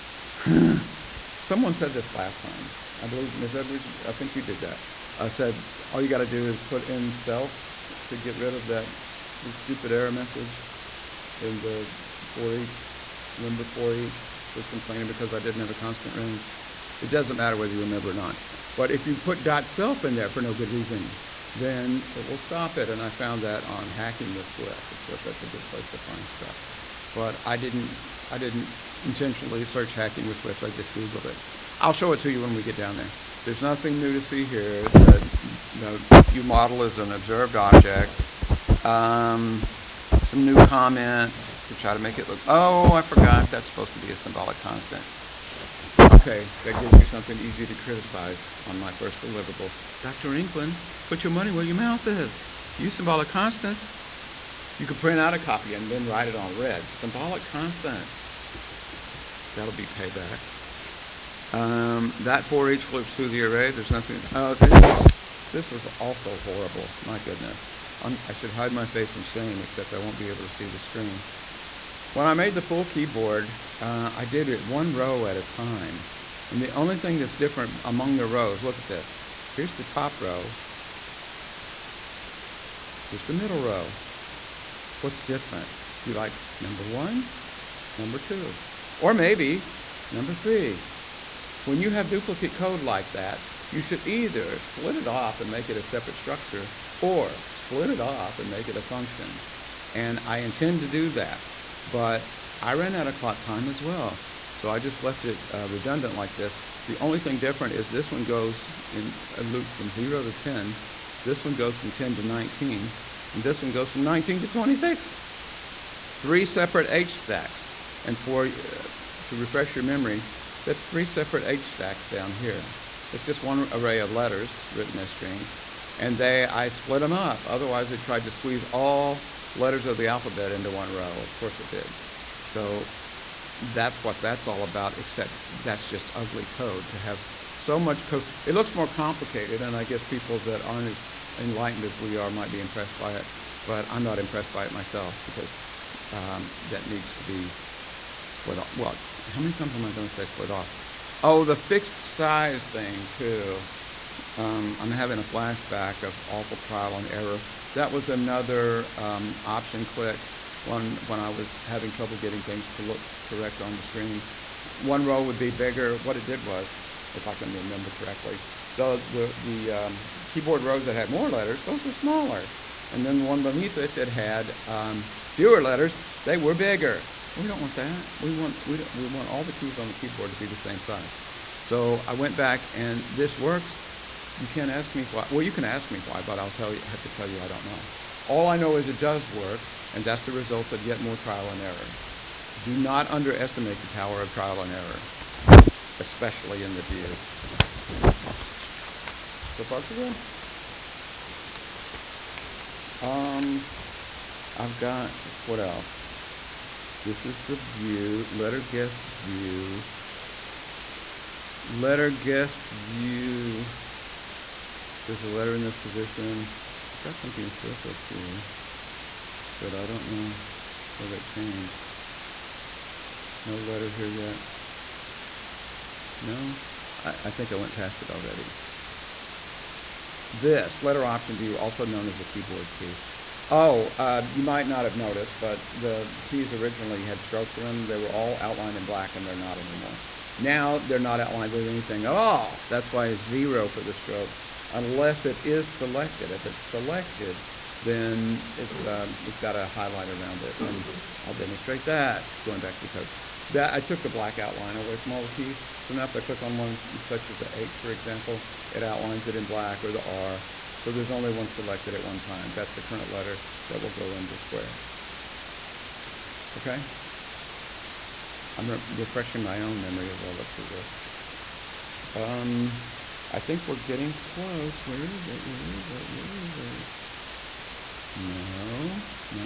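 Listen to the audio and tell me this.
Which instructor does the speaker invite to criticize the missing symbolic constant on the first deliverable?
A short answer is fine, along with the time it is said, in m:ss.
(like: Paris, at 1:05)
Dr. England, at 0:50.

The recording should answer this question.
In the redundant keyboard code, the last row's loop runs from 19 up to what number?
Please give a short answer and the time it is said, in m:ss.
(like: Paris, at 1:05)
26, at 1:54.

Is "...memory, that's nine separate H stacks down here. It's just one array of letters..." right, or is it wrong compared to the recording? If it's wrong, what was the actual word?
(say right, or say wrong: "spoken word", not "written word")
wrong: "three", not "nine".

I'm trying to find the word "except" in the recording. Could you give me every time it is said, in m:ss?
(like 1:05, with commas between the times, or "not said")
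1:09, 2:14.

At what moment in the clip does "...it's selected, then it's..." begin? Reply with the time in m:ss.
4:06.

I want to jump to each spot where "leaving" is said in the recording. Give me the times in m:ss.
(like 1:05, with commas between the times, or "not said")
not said.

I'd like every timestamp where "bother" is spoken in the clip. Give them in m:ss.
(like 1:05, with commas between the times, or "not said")
not said.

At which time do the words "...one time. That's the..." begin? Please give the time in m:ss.
4:22.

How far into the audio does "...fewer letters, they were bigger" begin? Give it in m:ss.
2:55.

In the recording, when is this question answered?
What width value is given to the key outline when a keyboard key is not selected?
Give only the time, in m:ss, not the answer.
4:03.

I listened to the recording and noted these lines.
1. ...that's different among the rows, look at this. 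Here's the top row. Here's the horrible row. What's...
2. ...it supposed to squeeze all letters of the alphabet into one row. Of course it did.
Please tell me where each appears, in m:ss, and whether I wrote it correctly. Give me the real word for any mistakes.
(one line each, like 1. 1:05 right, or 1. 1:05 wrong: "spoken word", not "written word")
1. 1:17 wrong: "middle", not "horrible"
2. 2:07 wrong: "tried", not "supposed".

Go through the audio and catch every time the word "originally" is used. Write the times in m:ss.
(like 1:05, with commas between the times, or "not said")
3:56.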